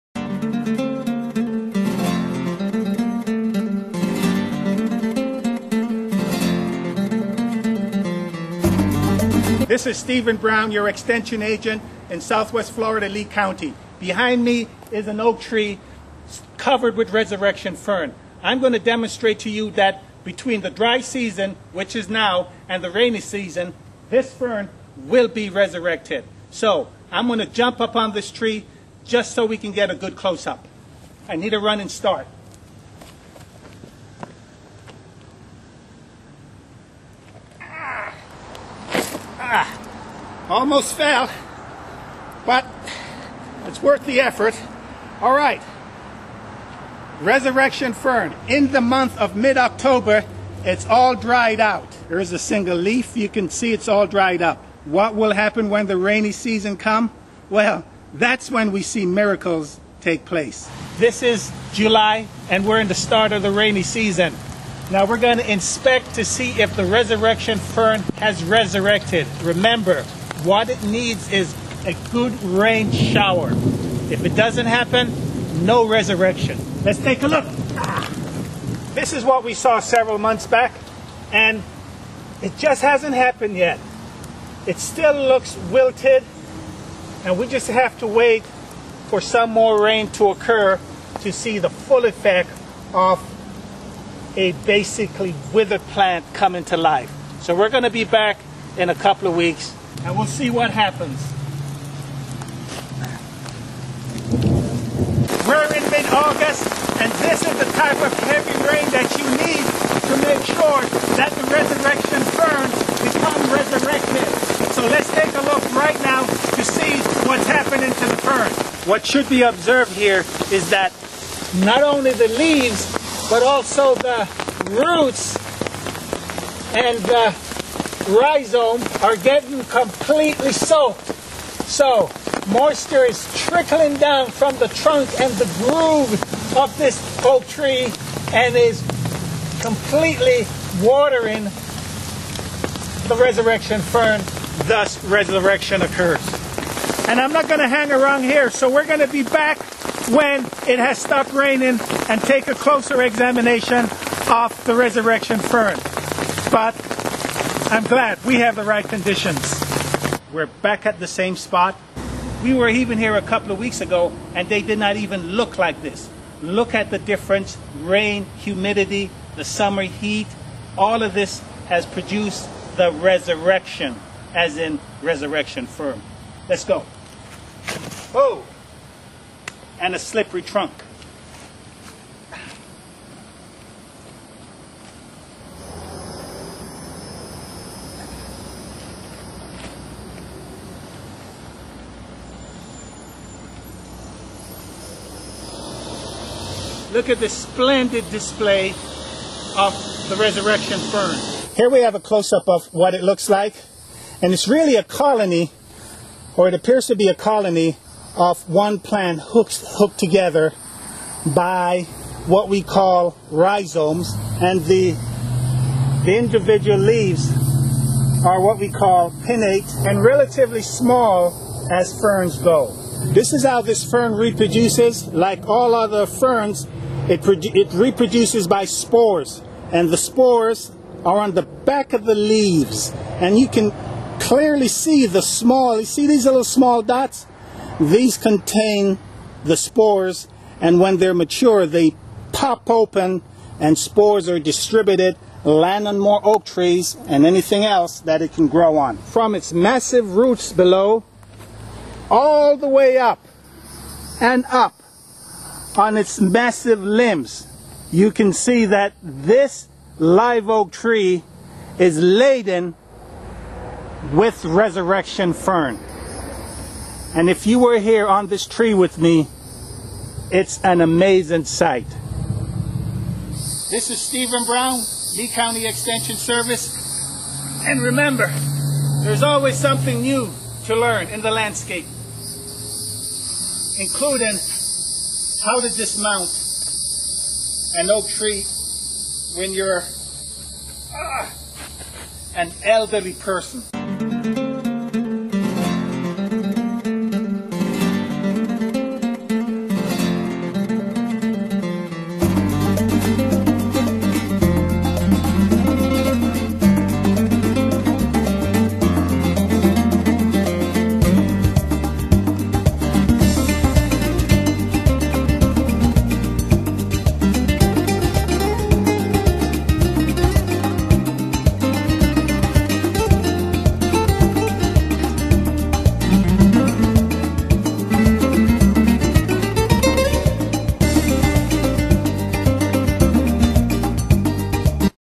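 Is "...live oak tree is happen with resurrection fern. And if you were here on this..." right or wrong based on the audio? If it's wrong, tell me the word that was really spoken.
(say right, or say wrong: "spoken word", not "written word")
wrong: "laden", not "happen".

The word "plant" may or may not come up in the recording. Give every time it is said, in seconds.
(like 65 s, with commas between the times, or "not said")
95 s, 208 s.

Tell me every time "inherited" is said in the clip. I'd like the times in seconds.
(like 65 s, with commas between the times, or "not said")
not said.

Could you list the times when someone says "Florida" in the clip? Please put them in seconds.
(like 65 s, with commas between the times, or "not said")
12 s.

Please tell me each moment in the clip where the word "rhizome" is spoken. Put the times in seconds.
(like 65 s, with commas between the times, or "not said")
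128 s, 213 s.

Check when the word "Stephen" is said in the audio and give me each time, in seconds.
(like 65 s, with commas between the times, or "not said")
9 s, 274 s.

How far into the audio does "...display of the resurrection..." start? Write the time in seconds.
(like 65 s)
198 s.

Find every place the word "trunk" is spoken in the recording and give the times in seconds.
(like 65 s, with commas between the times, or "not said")
134 s, 180 s.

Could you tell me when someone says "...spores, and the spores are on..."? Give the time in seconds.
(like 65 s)
228 s.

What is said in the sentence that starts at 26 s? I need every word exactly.
So I'm going to jump up on this tree just so we can get a good close-up.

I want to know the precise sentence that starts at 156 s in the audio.
But I'm glad we have the right conditions.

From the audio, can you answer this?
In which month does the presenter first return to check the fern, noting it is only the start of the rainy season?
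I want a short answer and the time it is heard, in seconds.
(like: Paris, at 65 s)
July, at 61 s.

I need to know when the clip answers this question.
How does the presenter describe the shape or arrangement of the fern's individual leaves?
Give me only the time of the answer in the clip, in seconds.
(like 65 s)
219 s.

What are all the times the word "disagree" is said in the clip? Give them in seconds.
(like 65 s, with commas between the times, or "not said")
not said.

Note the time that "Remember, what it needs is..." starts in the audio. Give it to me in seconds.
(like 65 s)
69 s.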